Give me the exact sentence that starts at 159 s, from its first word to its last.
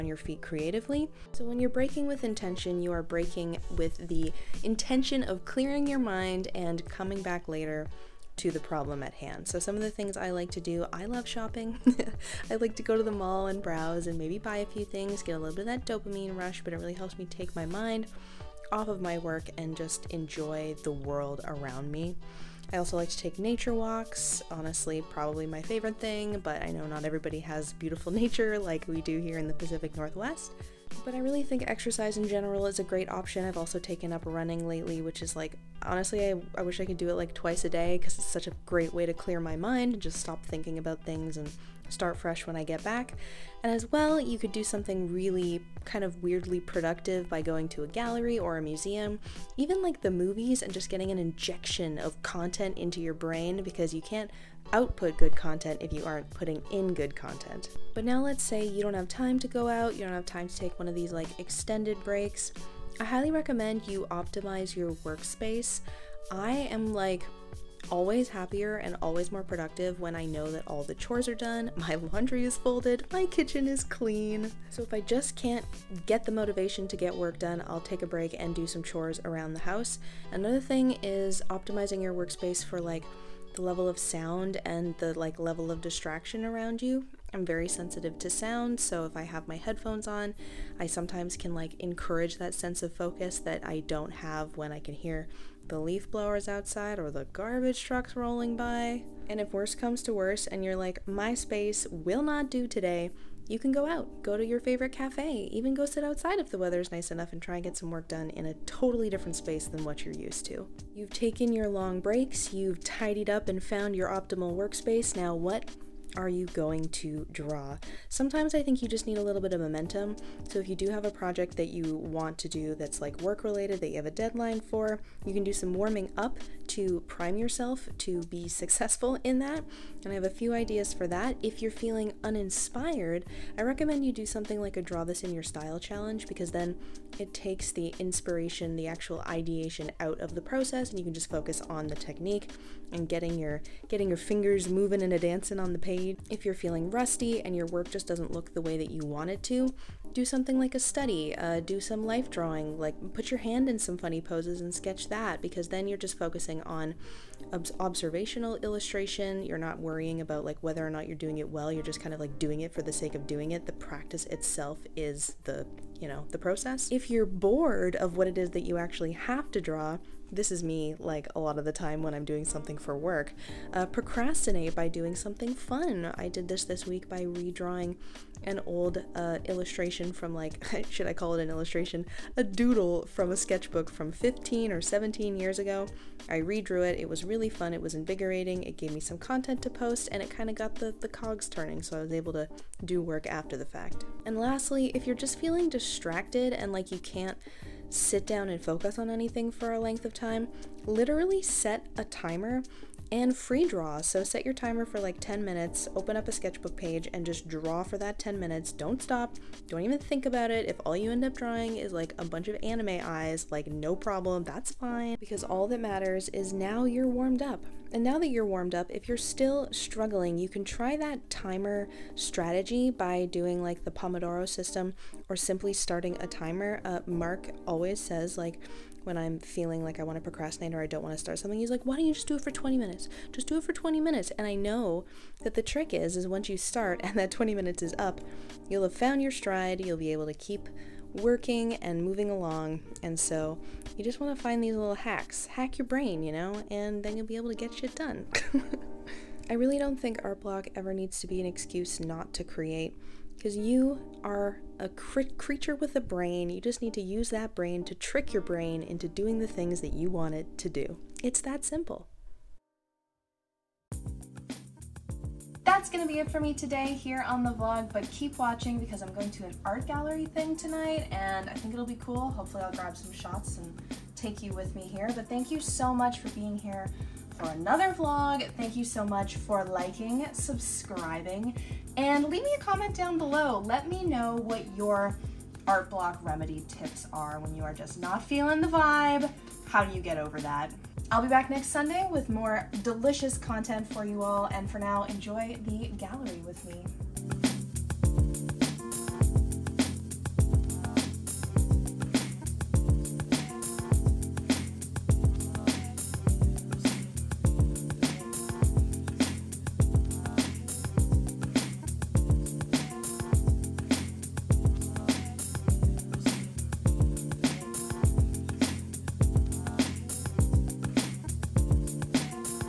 You're not worrying about like whether or not you're doing it well.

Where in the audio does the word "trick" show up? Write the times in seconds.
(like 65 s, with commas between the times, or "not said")
235 s, 257 s.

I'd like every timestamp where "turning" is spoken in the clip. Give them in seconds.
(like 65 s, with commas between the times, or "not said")
191 s.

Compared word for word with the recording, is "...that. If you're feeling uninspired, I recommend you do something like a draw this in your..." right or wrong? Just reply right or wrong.
right.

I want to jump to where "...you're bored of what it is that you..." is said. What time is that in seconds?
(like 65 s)
167 s.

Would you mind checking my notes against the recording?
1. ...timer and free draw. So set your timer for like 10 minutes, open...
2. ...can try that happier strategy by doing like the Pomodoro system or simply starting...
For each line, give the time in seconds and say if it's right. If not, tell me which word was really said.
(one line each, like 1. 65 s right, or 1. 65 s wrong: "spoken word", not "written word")
1. 202 s right
2. 220 s wrong: "timer", not "happier".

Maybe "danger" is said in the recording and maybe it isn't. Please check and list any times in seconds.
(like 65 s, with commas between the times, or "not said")
not said.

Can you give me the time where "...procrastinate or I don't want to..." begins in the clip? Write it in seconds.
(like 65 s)
230 s.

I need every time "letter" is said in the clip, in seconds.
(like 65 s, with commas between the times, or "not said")
not said.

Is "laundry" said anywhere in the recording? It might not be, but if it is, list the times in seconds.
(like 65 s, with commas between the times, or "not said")
72 s.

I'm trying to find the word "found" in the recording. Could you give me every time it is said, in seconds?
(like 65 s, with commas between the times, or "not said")
113 s, 238 s.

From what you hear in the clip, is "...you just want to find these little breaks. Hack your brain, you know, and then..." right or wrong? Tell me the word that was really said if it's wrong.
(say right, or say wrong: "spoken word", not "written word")
wrong: "hacks", not "breaks".